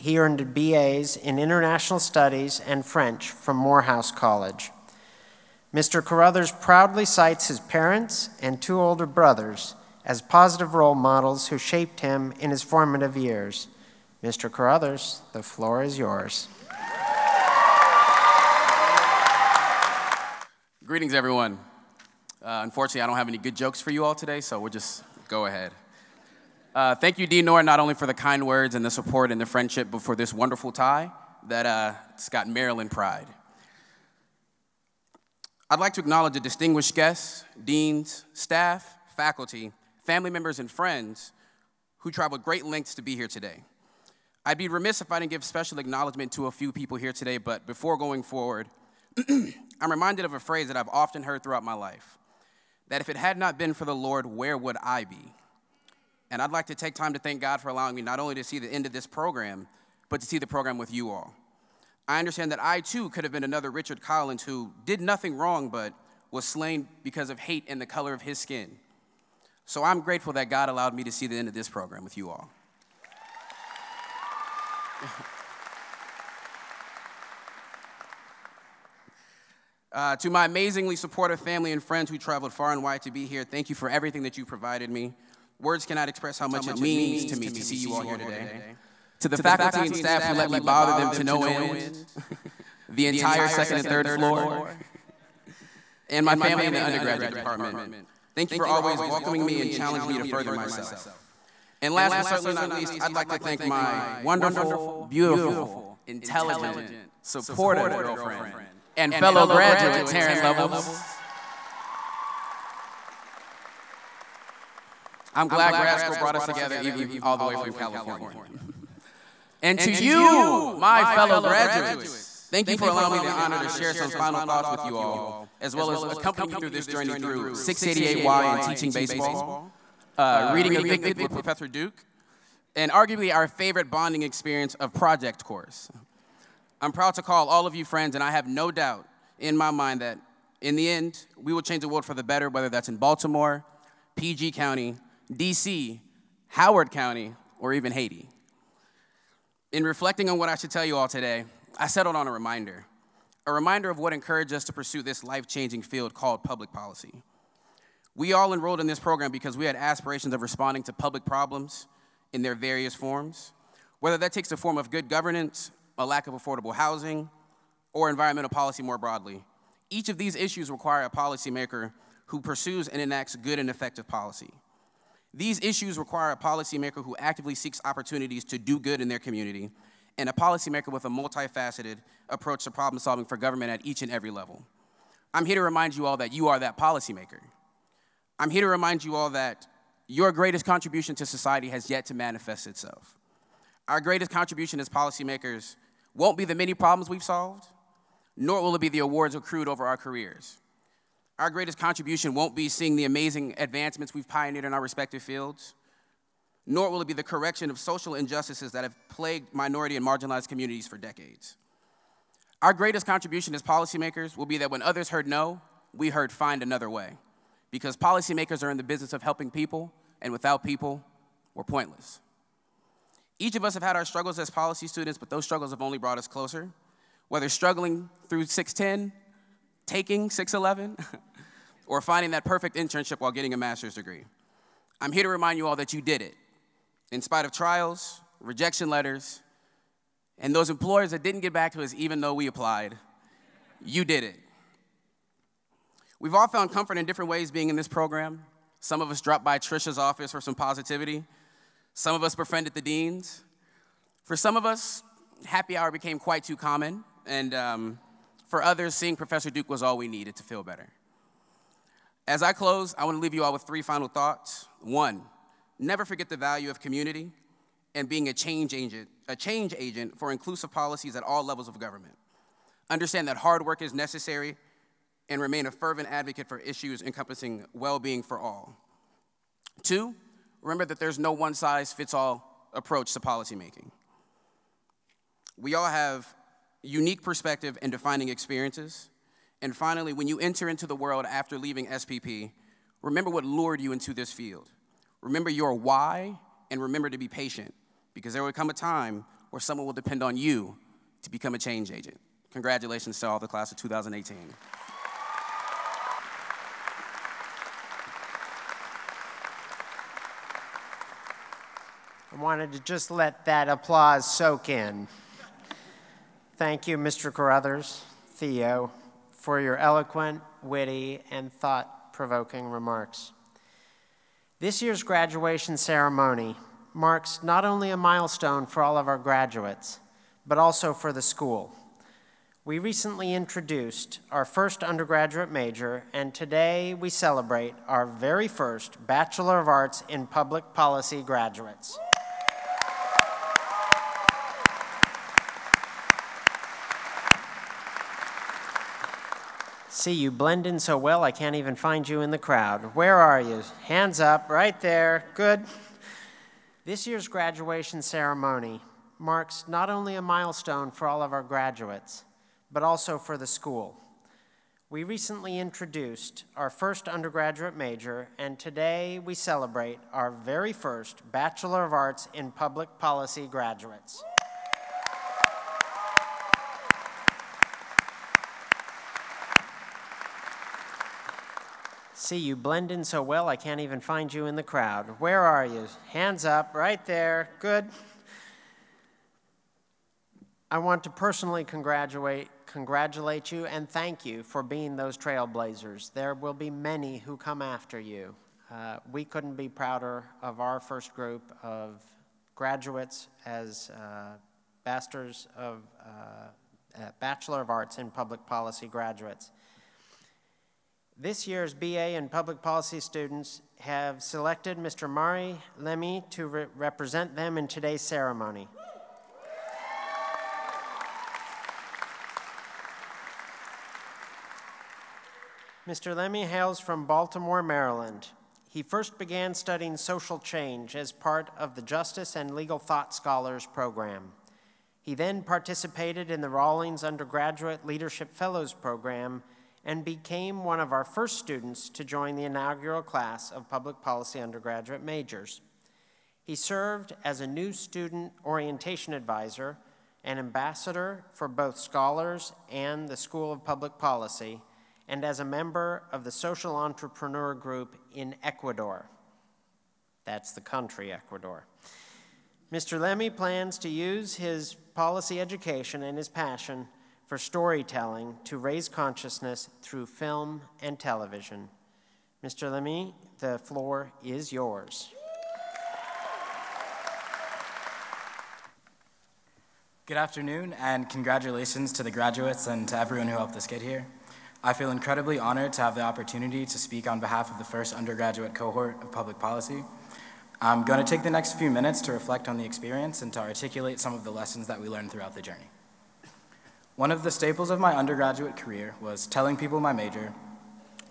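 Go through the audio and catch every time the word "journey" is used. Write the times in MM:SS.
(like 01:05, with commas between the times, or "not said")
02:06, 08:15.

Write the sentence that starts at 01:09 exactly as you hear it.
So I'm grateful that God allowed me to see the end of this program with you all.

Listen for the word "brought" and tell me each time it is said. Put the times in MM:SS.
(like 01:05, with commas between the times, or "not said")
01:56, 03:45.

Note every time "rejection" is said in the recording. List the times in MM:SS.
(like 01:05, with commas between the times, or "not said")
03:58.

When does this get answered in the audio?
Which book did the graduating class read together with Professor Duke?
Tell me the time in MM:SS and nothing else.
02:10.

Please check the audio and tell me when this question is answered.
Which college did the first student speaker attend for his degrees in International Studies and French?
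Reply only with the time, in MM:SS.
00:03.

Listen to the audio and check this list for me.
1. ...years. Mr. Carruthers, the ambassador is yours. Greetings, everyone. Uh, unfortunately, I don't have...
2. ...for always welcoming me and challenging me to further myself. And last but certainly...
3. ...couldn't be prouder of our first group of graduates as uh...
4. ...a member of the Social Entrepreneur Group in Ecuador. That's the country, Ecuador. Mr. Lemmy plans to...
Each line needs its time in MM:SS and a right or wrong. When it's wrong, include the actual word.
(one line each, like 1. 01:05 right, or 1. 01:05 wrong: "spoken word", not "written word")
1. 00:13 wrong: "floor", not "ambassador"
2. 01:38 right
3. 06:39 right
4. 07:35 right.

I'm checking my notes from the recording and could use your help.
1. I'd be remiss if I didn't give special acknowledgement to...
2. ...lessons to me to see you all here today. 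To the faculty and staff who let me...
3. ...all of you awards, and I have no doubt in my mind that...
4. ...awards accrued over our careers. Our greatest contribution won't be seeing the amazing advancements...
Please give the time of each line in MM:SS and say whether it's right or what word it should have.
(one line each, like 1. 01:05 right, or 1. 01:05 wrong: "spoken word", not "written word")
1. 00:44 right
2. 01:26 wrong: "means", not "lessons"
3. 02:17 wrong: "friends", not "awards"
4. 03:18 right.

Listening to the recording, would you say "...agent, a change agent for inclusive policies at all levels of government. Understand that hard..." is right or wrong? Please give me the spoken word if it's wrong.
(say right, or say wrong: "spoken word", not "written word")
right.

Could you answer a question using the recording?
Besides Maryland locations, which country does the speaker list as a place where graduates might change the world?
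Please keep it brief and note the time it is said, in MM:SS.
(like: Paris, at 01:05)
Haiti, at 02:27.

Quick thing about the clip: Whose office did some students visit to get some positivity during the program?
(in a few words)
Trisha.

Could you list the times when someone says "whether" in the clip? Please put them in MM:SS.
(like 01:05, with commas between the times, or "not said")
02:22, 02:44, 03:47.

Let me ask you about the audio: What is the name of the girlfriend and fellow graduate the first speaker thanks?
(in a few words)
Taryn Levels.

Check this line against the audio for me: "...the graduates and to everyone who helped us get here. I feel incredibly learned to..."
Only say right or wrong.
wrong.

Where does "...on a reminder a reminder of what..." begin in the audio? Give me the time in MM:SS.
02:32.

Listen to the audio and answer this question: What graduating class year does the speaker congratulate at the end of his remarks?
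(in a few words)
2018.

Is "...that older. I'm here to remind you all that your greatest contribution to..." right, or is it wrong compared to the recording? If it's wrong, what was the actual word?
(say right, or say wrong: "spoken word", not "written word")
wrong: "policymaker", not "older".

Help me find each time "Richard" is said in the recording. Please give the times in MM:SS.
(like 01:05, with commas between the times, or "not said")
01:03.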